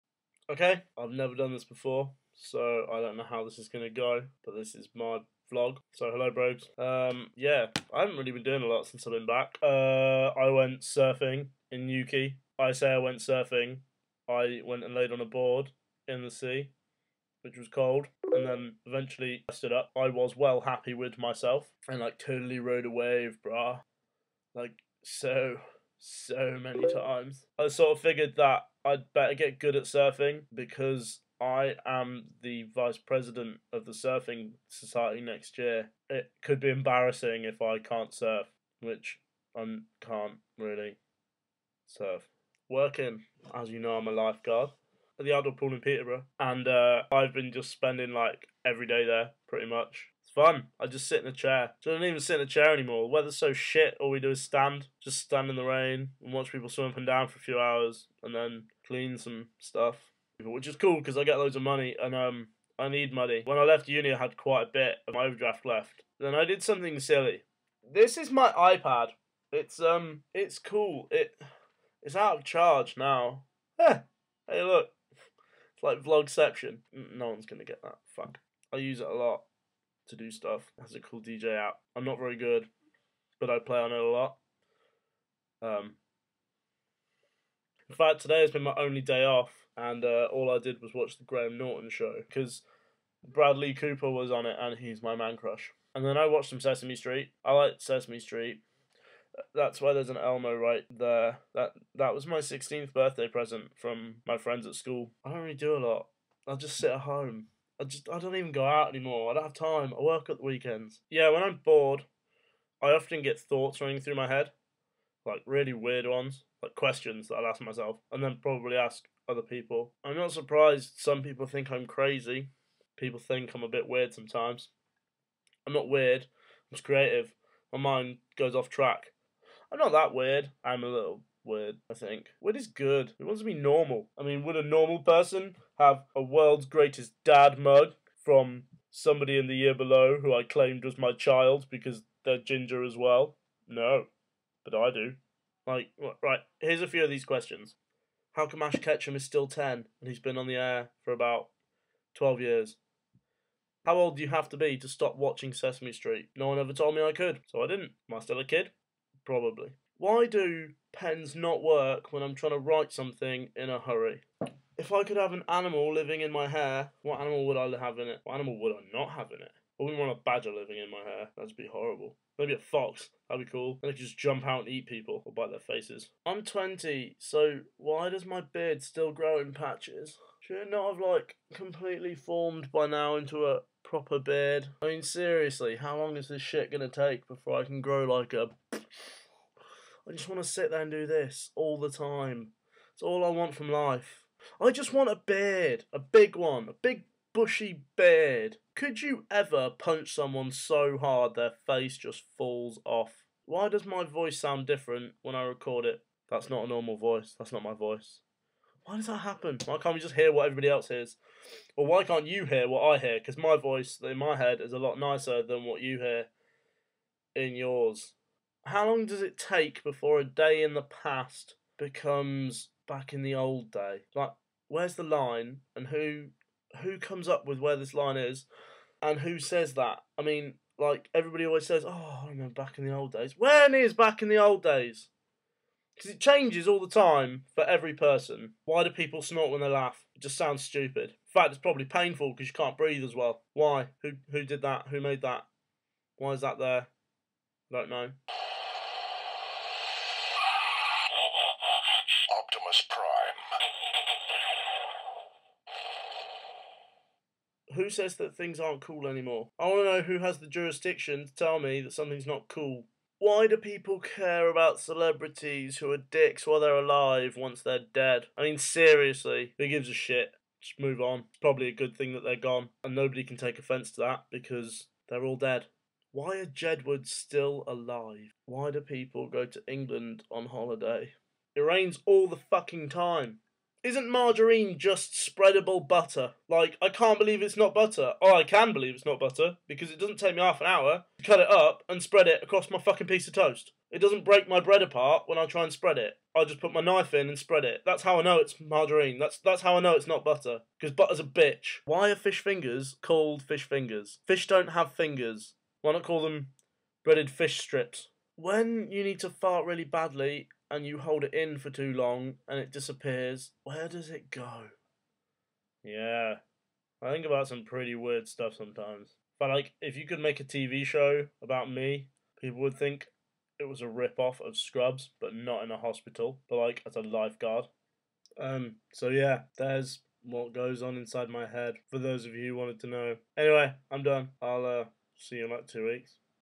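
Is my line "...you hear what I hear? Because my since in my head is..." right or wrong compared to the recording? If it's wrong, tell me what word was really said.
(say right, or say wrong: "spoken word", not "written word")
wrong: "voice", not "since".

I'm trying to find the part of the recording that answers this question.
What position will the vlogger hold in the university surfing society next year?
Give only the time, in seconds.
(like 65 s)
32 s.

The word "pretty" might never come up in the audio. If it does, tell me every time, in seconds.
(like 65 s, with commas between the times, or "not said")
49 s, 317 s.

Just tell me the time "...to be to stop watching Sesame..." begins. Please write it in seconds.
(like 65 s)
154 s.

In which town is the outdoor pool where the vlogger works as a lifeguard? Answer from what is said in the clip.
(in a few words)
Peterborough.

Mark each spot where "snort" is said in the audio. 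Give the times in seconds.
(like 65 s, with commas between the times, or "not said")
239 s.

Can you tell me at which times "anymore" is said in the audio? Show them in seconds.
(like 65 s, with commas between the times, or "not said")
52 s, 108 s, 259 s.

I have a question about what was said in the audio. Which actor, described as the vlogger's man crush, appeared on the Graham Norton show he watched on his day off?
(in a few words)
Bradley Cooper.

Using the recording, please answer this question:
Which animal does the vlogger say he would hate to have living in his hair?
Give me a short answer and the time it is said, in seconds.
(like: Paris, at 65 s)
badger, at 170 s.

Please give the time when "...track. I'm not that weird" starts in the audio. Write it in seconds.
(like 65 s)
128 s.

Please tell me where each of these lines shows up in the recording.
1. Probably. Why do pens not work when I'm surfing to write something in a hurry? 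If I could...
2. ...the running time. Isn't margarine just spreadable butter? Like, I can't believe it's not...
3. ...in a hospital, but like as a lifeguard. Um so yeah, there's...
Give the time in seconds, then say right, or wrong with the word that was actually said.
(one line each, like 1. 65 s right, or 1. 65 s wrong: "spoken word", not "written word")
1. 159 s wrong: "trying", not "surfing"
2. 282 s wrong: "fucking", not "running"
3. 325 s right.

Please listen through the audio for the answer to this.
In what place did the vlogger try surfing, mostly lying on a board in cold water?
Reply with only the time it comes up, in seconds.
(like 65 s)
11 s.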